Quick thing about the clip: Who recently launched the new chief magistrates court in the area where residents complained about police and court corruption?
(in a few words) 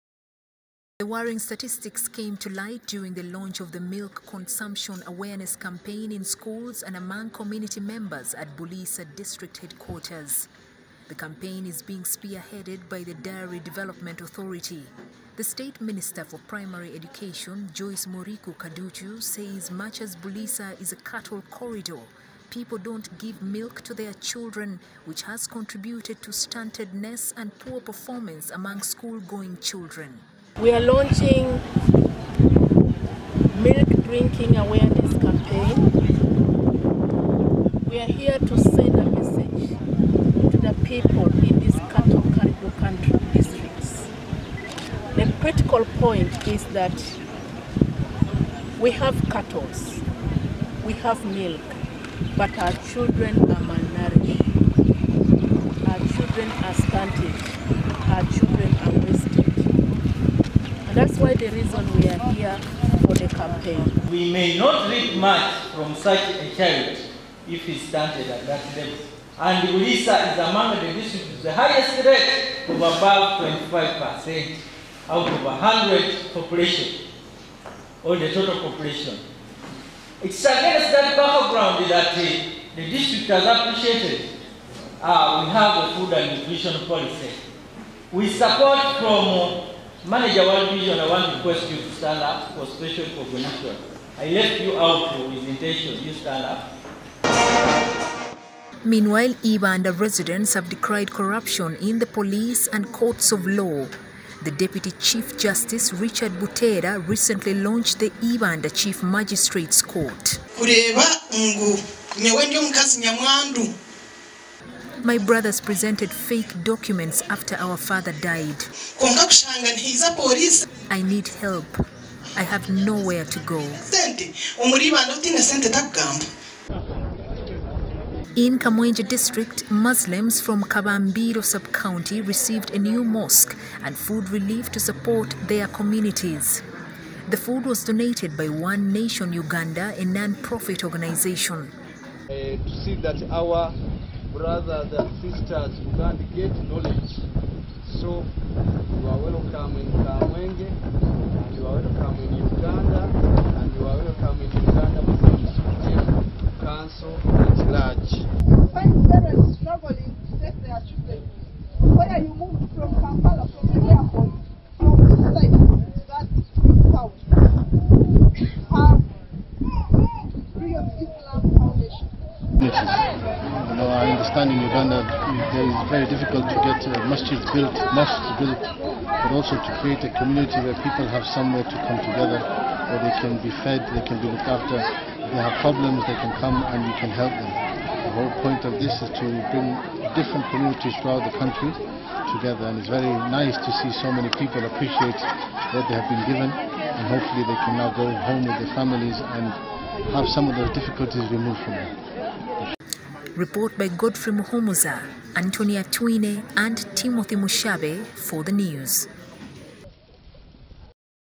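Richard Butera.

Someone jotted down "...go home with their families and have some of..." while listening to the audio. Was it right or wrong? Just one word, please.
right.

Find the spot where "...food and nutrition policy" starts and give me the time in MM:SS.
01:25.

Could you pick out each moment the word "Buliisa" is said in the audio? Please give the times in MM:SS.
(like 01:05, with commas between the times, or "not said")
00:08, 00:20, 01:09.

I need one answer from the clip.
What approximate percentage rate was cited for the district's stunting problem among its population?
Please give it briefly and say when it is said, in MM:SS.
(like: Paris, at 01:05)
25%, at 01:13.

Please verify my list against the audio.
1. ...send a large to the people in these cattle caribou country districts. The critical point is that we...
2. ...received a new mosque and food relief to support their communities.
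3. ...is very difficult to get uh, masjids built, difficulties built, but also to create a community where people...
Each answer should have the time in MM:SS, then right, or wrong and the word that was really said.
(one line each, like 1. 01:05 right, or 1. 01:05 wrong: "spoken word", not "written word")
1. 00:38 wrong: "message", not "large"
2. 02:12 right
3. 02:55 wrong: "mosques", not "difficulties".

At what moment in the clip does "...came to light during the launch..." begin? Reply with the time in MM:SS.
00:02.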